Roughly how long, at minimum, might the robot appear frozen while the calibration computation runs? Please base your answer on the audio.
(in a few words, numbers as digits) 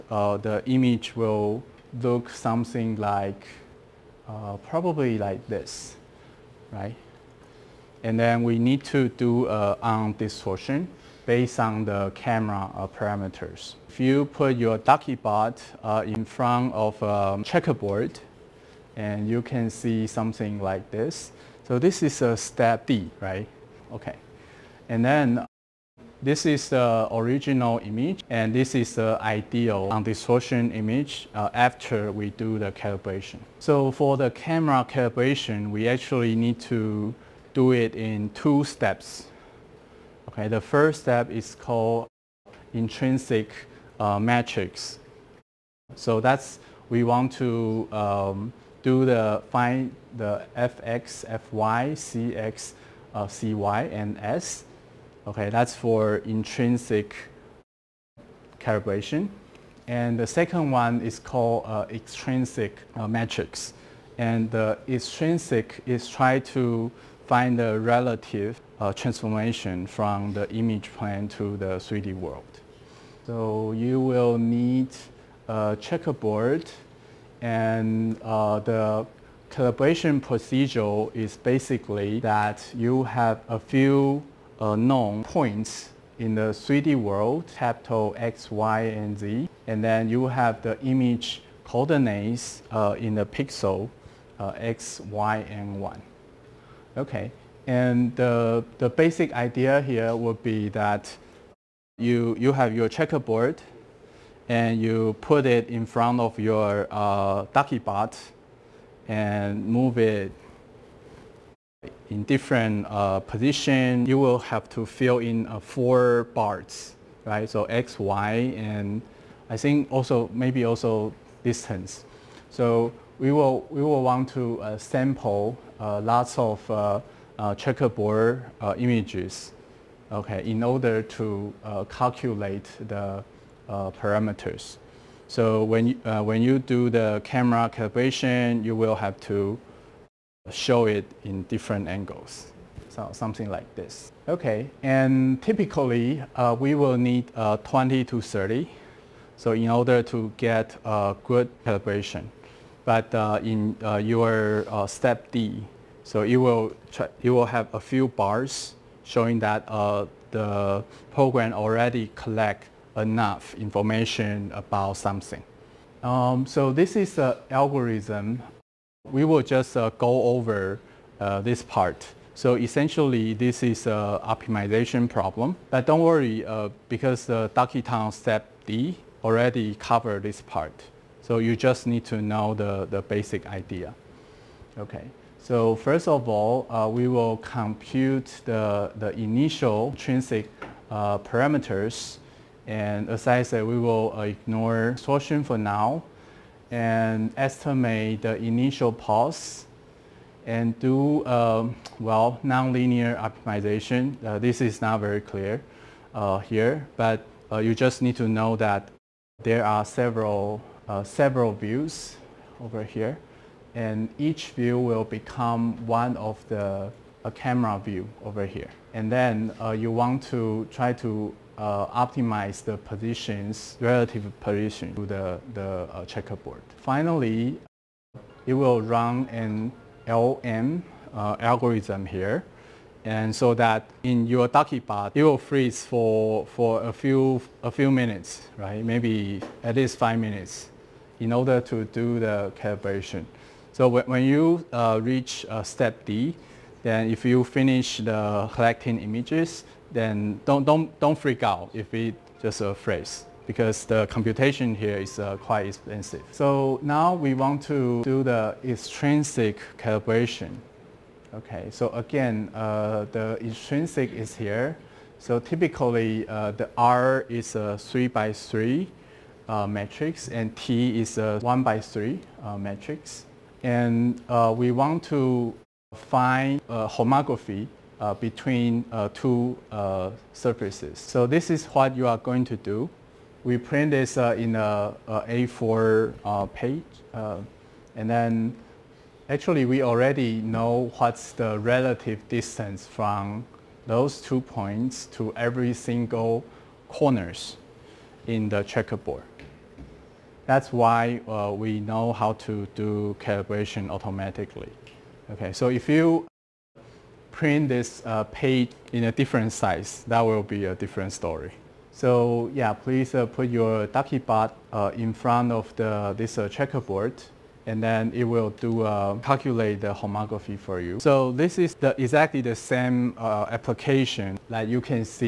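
5 minutes.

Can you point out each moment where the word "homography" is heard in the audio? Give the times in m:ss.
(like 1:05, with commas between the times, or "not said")
4:36, 5:19.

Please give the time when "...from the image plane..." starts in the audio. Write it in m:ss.
1:09.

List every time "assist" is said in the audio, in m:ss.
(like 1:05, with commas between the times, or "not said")
not said.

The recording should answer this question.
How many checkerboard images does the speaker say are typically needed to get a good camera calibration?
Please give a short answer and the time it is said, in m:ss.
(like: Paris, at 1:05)
20 to 30, at 2:27.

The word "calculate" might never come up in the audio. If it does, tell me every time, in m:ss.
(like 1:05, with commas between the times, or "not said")
2:11, 5:19.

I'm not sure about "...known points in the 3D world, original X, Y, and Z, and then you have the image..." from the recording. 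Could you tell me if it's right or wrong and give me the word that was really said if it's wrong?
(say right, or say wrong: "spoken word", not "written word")
wrong: "capital", not "original".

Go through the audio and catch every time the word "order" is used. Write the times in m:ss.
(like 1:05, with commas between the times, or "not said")
2:10, 2:29, 4:01.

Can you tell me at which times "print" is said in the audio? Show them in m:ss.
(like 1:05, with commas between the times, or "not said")
4:43, 5:07.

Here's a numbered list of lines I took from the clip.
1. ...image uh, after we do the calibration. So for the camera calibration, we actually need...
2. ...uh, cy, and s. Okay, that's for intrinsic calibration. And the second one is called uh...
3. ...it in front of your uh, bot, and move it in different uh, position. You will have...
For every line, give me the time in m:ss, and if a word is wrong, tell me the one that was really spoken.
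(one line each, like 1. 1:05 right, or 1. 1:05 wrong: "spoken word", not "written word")
1. 0:30 right
2. 0:53 right
3. 1:45 right.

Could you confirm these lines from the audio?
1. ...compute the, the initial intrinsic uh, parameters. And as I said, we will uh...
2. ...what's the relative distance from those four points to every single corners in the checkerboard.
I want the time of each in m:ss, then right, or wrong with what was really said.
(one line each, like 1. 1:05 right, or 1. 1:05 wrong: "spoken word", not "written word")
1. 3:07 right
2. 4:50 wrong: "two", not "four".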